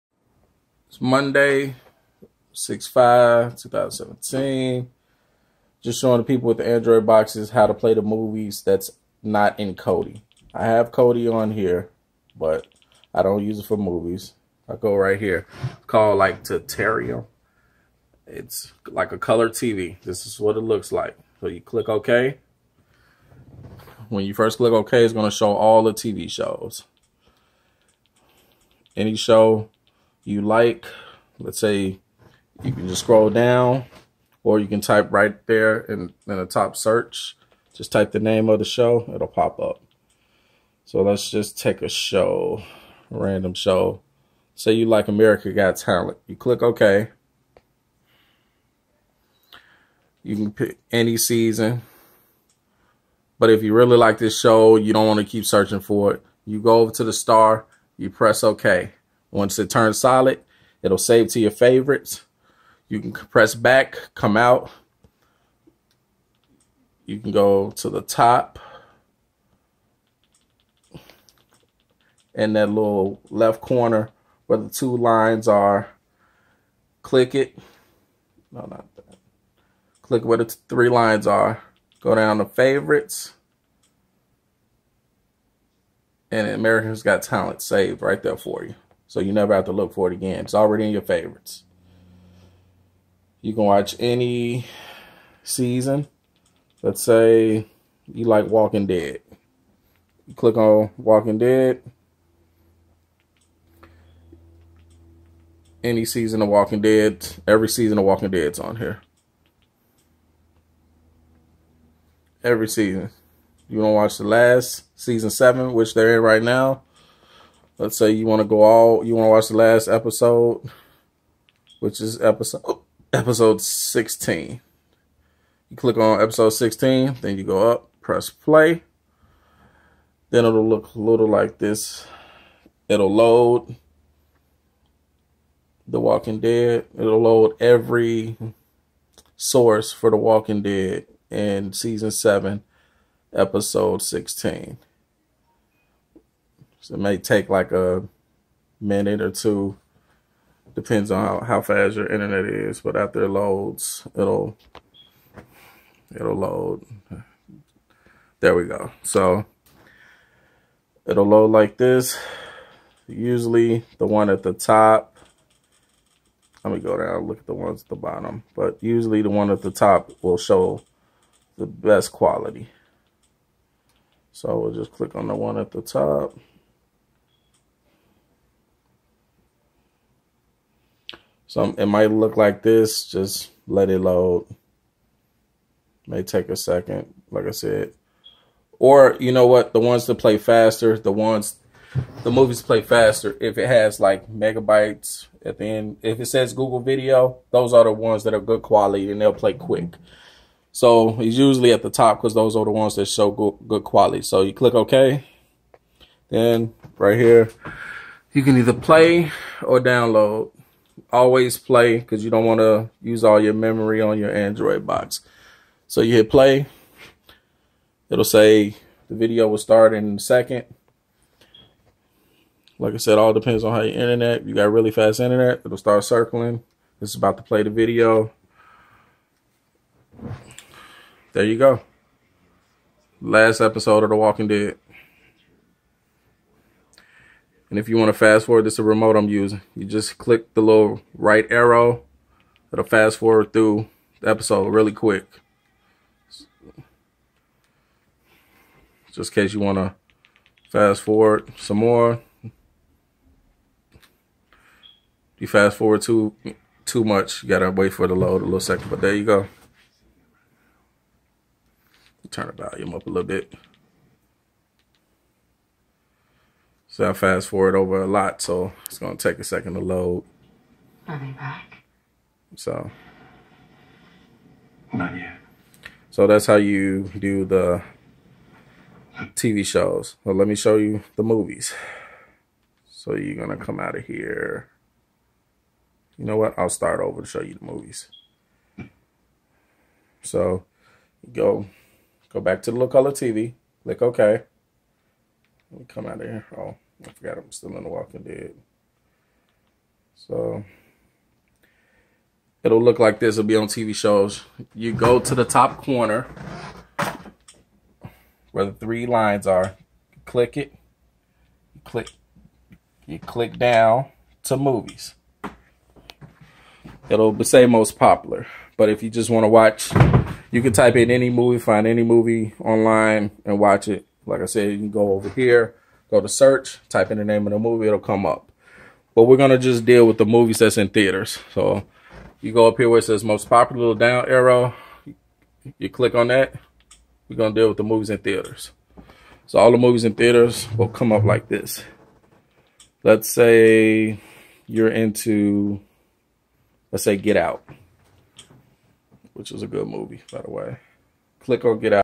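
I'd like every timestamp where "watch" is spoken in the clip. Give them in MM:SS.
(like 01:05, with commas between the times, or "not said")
01:33, 01:53, 01:59, 05:19, 05:23.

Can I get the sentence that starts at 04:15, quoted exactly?
You fast forward too too much.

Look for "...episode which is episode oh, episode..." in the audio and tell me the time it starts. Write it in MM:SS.
01:59.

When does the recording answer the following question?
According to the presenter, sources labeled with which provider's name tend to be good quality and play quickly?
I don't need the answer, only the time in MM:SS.
03:16.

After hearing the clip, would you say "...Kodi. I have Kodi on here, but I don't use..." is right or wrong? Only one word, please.
right.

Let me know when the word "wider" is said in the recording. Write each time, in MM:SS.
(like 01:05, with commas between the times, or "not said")
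not said.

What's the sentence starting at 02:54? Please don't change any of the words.
So we'll just click on the one at the top.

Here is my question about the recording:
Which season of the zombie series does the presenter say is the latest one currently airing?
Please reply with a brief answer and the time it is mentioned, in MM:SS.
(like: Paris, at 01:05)
7, at 01:55.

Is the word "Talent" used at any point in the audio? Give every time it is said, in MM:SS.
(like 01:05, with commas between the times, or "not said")
00:45, 01:27.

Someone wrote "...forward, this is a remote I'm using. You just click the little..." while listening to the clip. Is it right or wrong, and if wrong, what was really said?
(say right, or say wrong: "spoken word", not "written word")
right.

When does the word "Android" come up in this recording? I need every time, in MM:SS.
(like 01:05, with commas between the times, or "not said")
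00:06, 03:34.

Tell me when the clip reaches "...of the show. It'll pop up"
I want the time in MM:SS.
00:38.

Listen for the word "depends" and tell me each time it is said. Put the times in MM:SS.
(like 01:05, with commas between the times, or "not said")
02:30, 03:43.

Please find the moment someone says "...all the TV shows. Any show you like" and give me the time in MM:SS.
00:25.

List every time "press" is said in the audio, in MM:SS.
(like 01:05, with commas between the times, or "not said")
00:58, 01:03, 02:07.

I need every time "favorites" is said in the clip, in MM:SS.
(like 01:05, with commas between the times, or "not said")
01:01, 01:22, 01:31.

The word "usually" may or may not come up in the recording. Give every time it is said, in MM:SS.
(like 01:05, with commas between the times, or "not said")
02:43, 02:48, 03:21.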